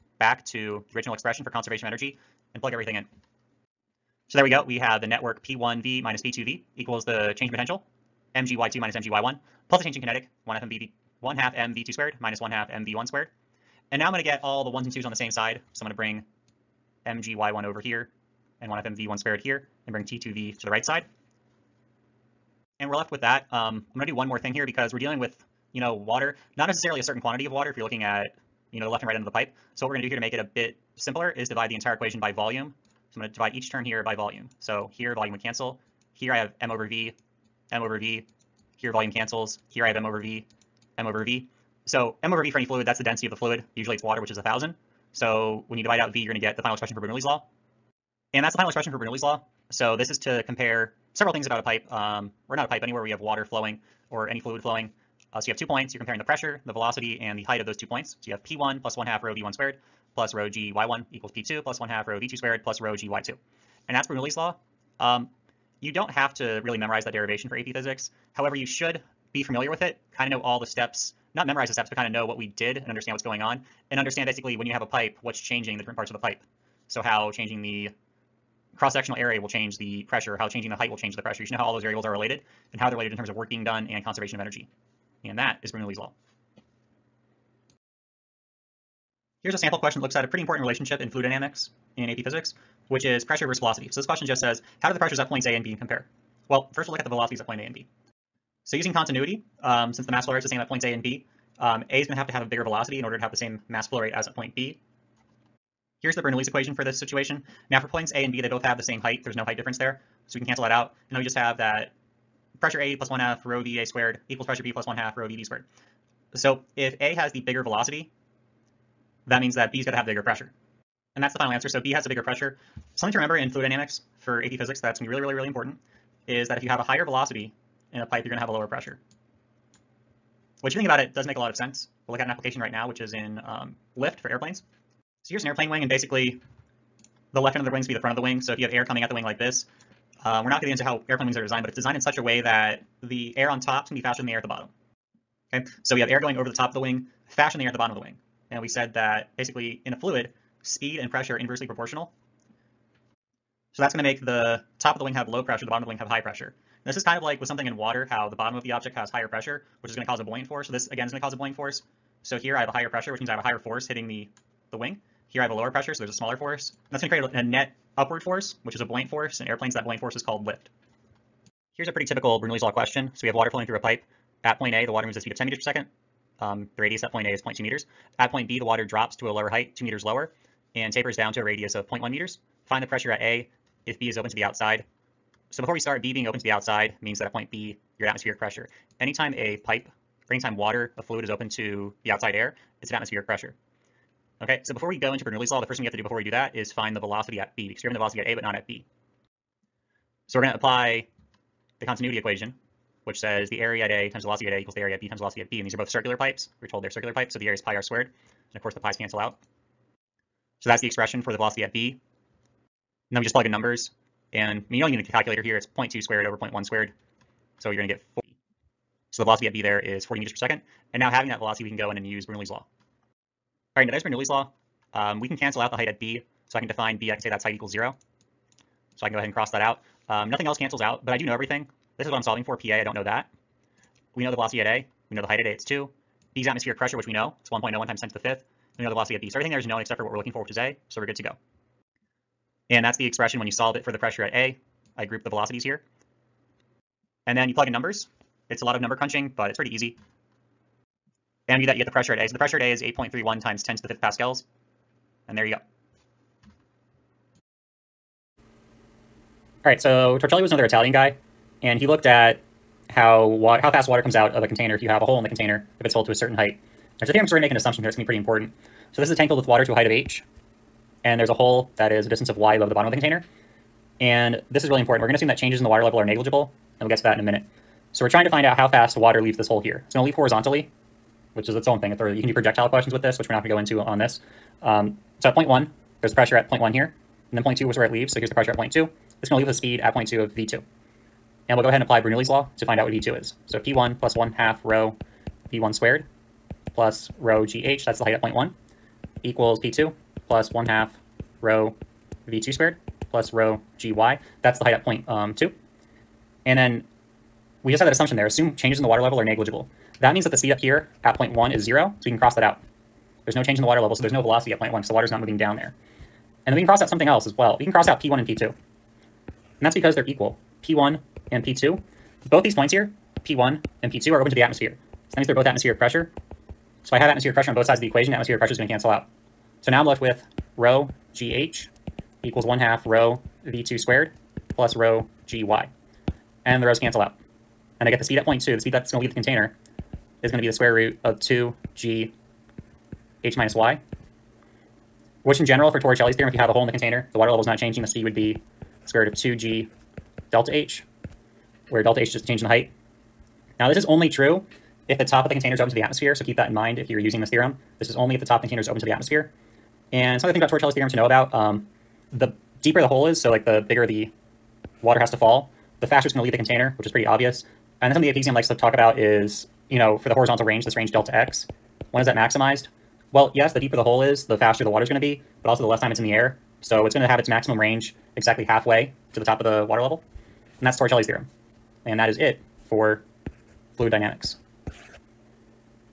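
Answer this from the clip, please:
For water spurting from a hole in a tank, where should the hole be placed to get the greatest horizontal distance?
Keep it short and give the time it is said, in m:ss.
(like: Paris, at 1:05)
Halfway to the top, at 6:18.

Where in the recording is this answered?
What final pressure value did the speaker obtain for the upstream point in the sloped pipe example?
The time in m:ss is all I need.
4:12.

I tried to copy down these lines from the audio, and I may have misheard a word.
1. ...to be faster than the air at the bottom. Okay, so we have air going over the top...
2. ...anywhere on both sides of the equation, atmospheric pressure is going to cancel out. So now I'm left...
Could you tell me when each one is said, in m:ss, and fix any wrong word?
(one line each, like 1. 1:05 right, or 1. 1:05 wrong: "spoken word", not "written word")
1. 2:23 right
2. 5:27 wrong: "pressure", not "anywhere".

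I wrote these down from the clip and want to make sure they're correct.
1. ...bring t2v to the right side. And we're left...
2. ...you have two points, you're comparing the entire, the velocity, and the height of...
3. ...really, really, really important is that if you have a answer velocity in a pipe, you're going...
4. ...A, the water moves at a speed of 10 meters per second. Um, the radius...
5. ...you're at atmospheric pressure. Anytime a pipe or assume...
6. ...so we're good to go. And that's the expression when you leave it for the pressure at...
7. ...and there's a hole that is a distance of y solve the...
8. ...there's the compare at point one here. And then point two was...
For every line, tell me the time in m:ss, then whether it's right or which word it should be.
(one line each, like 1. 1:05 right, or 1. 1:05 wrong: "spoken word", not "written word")
1. 0:19 right
2. 0:55 wrong: "pressure", not "entire"
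3. 2:05 wrong: "higher", not "answer"
4. 2:54 right
5. 3:07 wrong: "anytime", not "assume"
6. 4:00 wrong: "solve", not "leave"
7. 4:31 wrong: "above", not "solve"
8. 4:46 wrong: "pressure", not "compare".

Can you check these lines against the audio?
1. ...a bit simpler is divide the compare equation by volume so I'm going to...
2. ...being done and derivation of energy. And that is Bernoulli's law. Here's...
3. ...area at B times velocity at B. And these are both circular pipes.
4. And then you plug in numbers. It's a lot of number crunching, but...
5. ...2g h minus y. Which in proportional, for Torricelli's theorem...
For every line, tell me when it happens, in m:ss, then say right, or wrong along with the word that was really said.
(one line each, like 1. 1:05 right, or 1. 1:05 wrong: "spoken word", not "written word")
1. 0:30 wrong: "entire", not "compare"
2. 1:23 wrong: "conservation", not "derivation"
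3. 3:24 right
4. 4:07 right
5. 5:41 wrong: "general", not "proportional".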